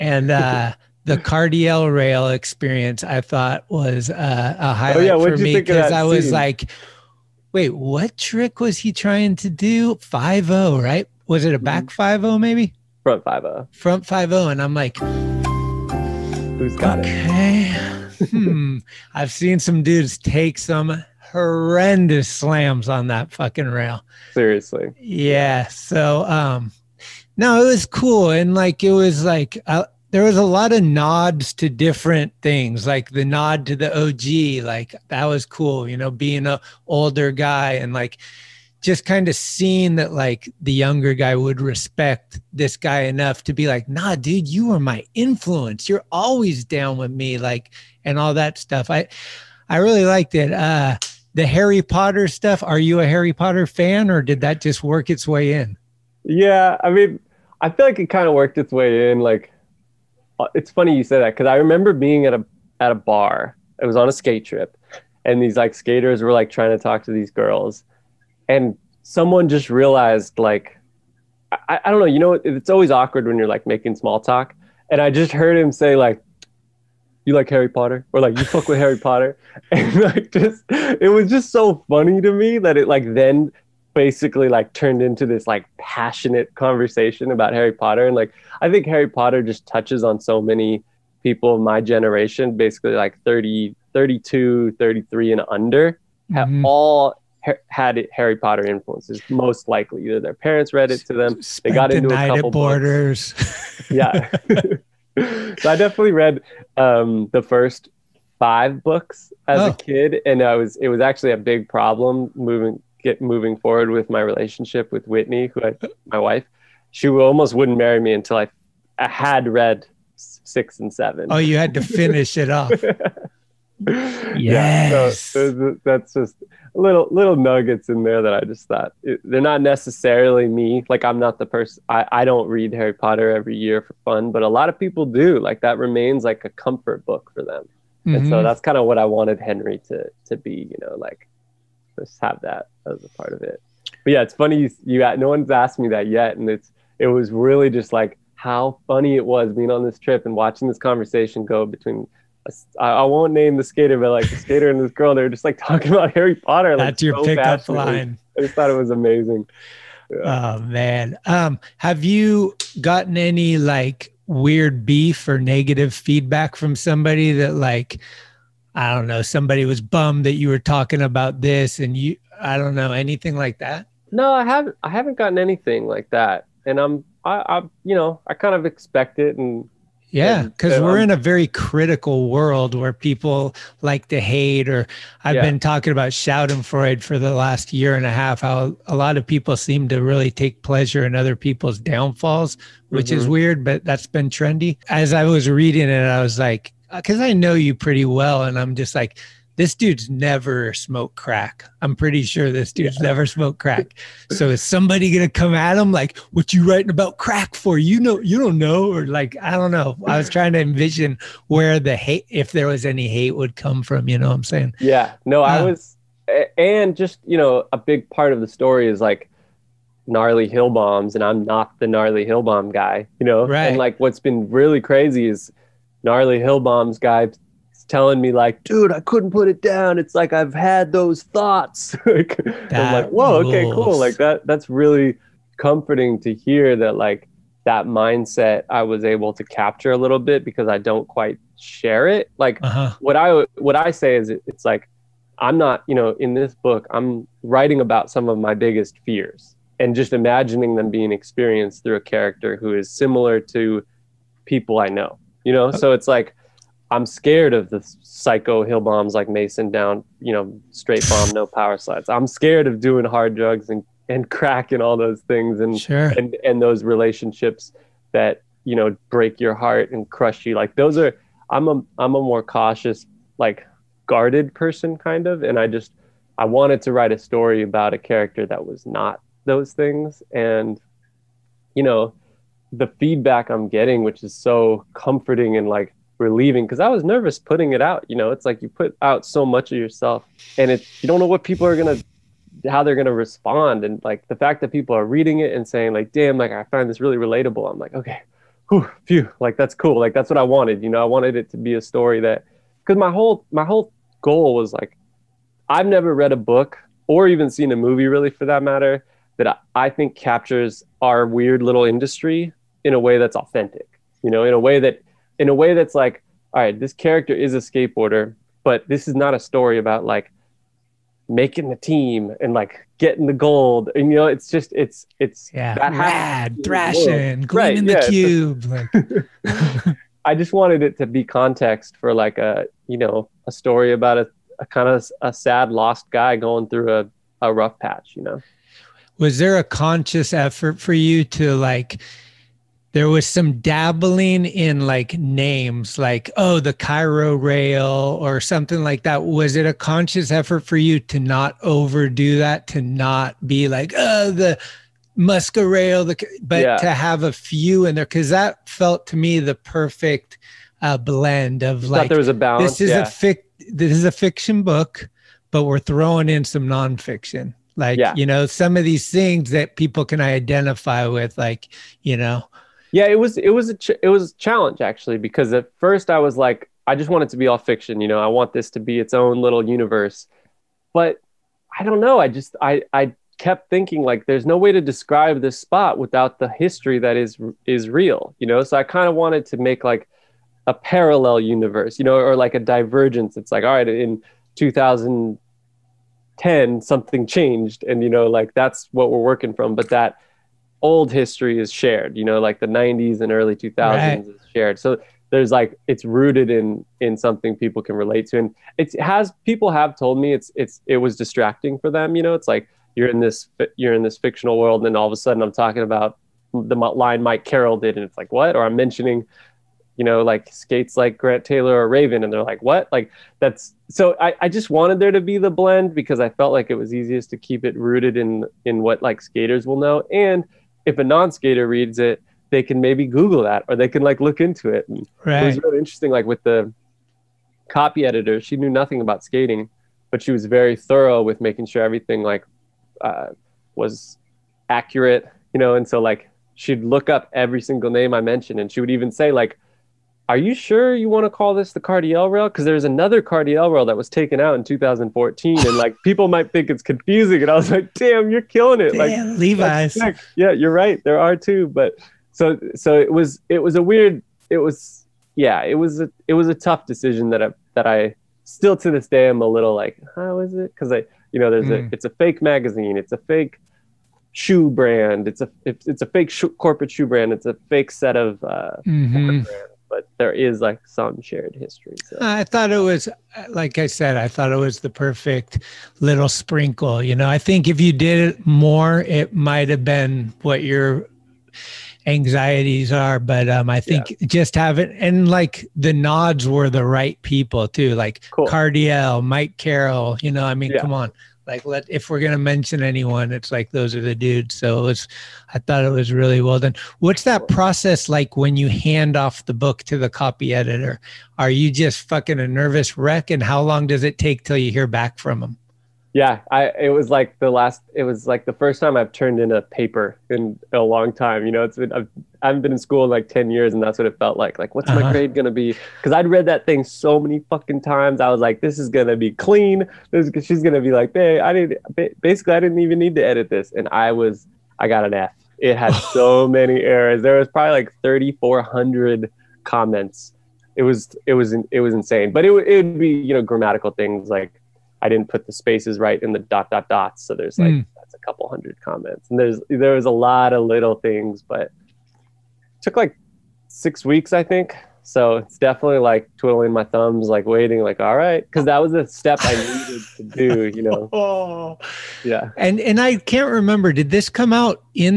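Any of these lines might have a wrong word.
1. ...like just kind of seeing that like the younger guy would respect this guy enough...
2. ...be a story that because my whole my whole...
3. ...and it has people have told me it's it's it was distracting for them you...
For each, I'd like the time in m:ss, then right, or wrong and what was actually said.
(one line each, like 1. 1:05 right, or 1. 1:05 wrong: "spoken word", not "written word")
1. 0:37 right
2. 5:01 right
3. 6:48 right.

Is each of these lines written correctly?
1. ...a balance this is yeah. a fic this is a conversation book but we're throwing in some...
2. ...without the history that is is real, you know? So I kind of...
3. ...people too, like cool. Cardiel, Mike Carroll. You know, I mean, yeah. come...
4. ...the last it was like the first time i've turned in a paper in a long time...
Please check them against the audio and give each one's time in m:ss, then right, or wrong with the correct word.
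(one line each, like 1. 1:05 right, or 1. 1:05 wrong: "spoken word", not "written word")
1. 6:02 wrong: "fiction", not "conversation"
2. 6:25 right
3. 8:17 right
4. 8:37 right.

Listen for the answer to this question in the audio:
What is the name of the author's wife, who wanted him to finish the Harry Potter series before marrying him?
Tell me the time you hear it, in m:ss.
1:55.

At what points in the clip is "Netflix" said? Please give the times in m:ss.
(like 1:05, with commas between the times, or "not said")
not said.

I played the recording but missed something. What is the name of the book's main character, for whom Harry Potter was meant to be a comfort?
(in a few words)
Henry.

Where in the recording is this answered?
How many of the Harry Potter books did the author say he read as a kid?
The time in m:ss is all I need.
1:47.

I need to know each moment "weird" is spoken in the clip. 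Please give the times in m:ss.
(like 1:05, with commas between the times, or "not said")
2:44, 3:13, 5:11, 7:43.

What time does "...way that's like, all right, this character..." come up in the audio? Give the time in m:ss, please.
5:15.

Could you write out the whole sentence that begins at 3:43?
And like, what's been really crazy is gnarly hill bombs guy telling me like, dude, I couldn't put it down.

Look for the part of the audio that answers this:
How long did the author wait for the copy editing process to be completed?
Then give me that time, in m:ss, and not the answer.
9:13.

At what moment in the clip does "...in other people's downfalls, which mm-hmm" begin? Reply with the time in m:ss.
3:11.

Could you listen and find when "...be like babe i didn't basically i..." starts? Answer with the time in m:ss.
8:50.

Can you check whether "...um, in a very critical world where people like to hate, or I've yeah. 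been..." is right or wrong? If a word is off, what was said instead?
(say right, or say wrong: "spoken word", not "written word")
right.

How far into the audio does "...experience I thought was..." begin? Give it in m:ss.
0:02.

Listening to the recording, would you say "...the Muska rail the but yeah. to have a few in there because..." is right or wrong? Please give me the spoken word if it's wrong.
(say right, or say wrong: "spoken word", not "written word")
right.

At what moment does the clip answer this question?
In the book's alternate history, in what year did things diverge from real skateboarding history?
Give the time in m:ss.
6:34.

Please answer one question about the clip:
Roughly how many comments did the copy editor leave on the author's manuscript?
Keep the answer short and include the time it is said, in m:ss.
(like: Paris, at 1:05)
3400, at 8:58.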